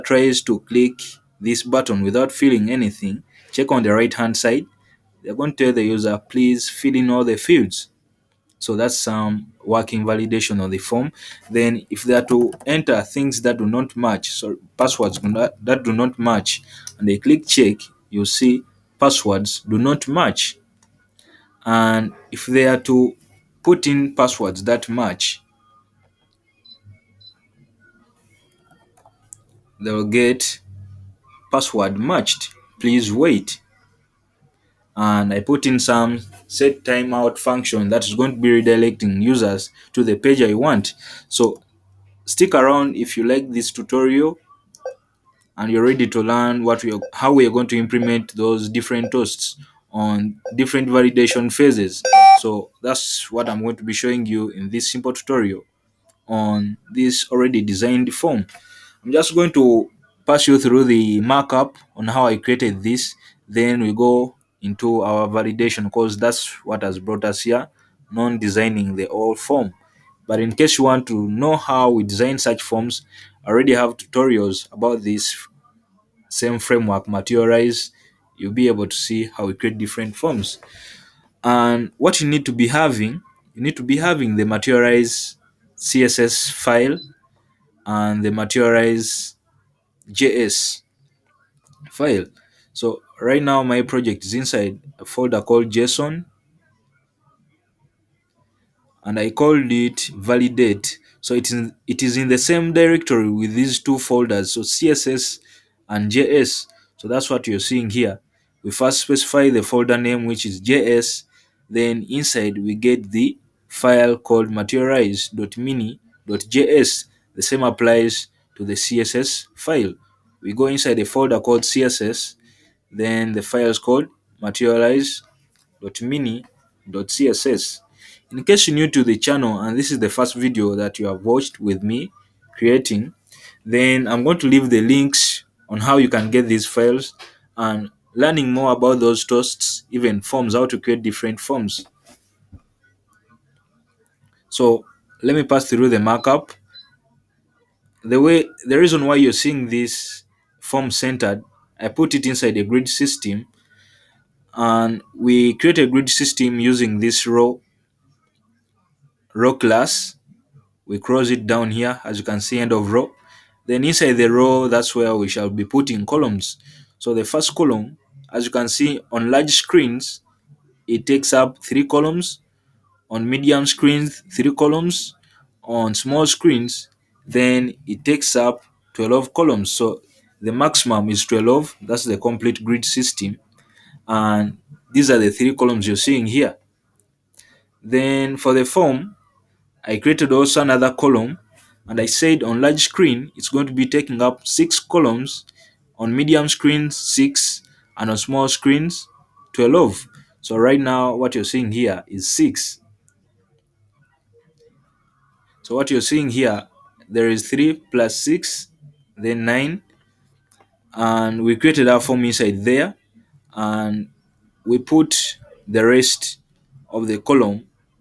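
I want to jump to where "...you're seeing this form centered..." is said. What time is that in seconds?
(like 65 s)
149 s.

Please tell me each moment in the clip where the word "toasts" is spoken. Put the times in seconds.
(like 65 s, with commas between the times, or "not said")
49 s, 139 s.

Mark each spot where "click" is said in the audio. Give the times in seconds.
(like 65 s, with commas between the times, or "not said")
0 s, 17 s.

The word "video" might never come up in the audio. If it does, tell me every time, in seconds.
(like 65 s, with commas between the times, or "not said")
130 s.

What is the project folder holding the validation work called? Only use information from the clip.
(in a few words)
validate.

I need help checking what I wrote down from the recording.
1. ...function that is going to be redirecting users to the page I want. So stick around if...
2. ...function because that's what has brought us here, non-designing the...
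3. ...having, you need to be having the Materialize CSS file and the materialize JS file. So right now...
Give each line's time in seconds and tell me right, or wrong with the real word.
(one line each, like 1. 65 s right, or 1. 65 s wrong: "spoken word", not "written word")
1. 37 s right
2. 65 s wrong: "validation", not "function"
3. 82 s right.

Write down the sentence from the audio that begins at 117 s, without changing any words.
The same applies to the CSS file.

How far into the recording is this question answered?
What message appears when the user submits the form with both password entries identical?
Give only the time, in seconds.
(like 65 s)
31 s.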